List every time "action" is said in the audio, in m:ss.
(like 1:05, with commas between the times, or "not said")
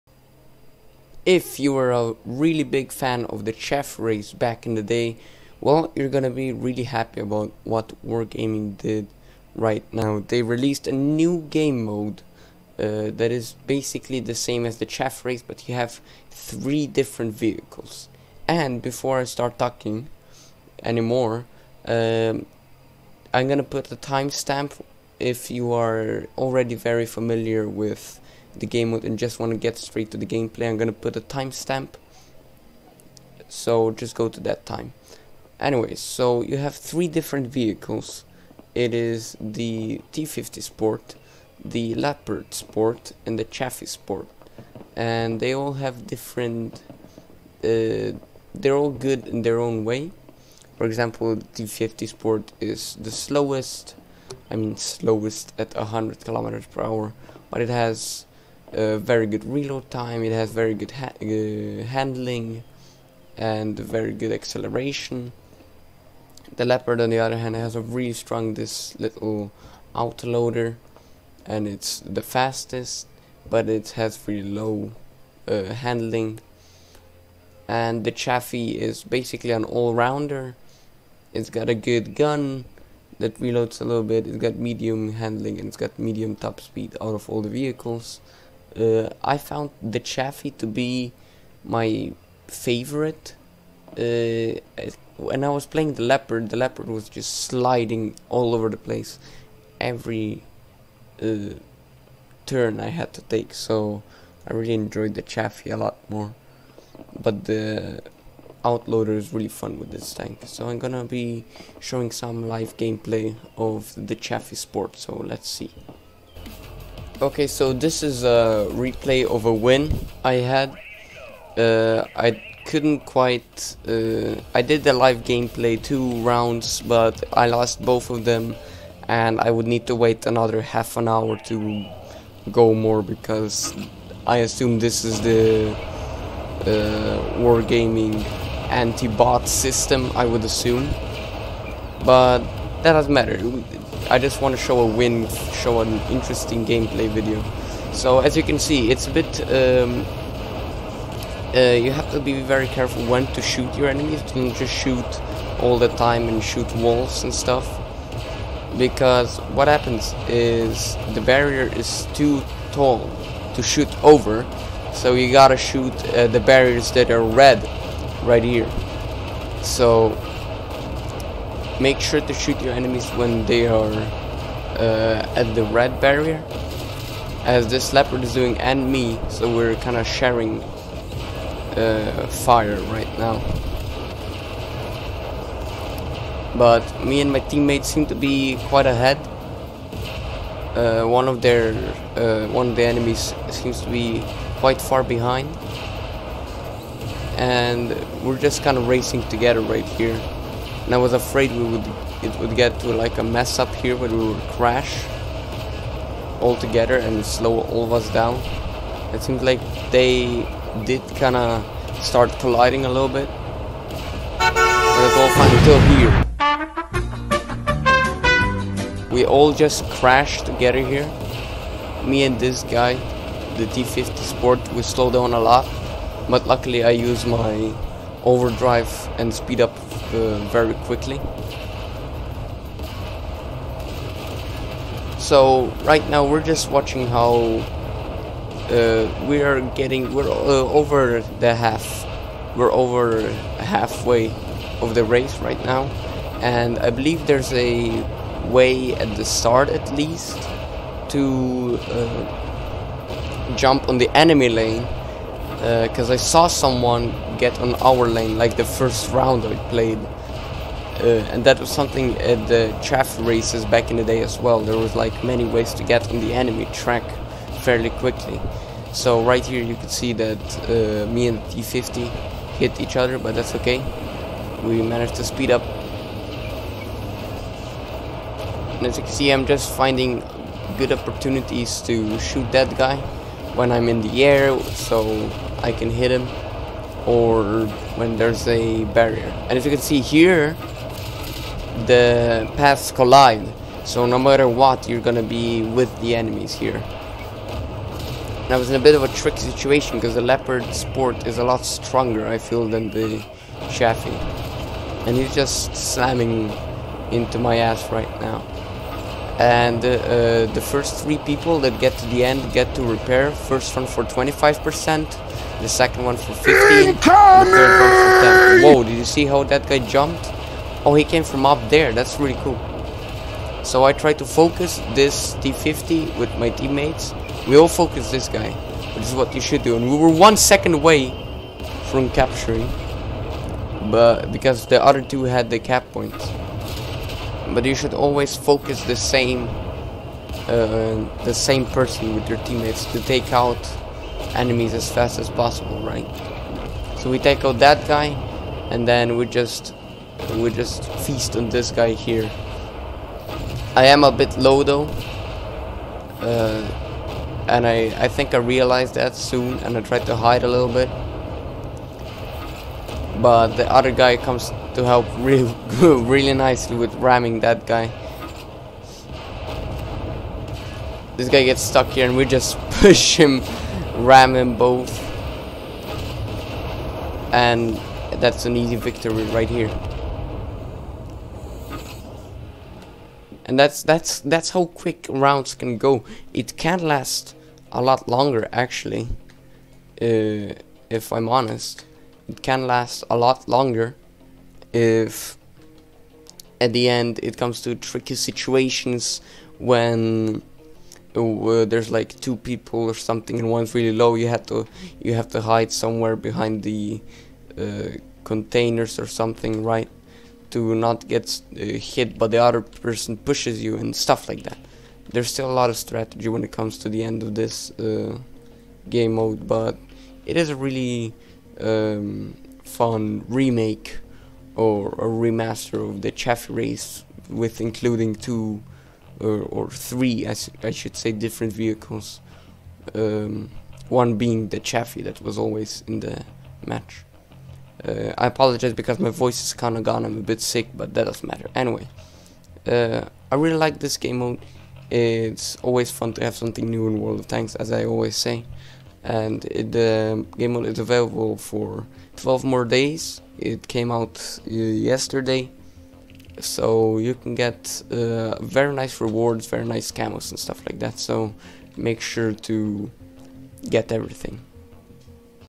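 not said.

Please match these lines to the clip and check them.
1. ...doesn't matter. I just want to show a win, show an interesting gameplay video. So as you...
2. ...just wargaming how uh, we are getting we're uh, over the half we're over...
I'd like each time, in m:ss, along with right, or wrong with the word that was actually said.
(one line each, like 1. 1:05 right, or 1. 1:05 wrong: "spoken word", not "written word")
1. 2:22 right
2. 3:56 wrong: "watching", not "wargaming".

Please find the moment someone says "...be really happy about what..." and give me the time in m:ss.
0:06.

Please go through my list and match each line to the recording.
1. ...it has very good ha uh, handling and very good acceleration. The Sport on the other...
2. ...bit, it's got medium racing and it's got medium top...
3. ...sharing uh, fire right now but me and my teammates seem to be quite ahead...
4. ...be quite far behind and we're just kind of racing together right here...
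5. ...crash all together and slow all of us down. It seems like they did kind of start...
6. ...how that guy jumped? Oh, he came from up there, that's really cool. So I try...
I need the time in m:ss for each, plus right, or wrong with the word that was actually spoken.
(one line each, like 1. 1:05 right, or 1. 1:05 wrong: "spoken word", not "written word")
1. 1:00 wrong: "Leopard", not "Sport"
2. 1:24 wrong: "handling", not "racing"
3. 3:00 right
4. 3:13 right
5. 3:24 right
6. 5:19 right.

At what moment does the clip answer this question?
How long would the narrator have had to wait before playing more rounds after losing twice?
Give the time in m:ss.
2:10.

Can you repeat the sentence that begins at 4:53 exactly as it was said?
So no matter what, you're gonna be with the enemies here.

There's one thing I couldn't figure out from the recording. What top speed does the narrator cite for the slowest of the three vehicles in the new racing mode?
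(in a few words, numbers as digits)
100 km/h.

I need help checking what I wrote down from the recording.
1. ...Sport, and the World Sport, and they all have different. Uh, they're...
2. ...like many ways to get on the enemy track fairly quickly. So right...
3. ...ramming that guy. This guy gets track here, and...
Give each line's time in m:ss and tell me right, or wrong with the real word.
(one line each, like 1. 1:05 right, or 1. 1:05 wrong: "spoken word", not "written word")
1. 0:42 wrong: "Chaffee", not "World"
2. 4:24 right
3. 6:06 wrong: "stuck", not "track".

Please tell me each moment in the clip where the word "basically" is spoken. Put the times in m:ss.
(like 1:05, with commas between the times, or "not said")
0:13, 1:19.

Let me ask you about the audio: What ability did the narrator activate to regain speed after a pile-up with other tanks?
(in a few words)
Overdrive.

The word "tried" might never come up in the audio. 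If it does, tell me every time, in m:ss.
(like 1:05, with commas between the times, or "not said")
5:59.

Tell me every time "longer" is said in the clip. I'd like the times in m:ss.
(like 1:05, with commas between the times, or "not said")
6:28, 6:33.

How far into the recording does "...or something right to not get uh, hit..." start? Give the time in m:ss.
6:48.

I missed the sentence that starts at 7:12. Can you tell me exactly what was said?
Um, one being the Chaffee that was always in the match.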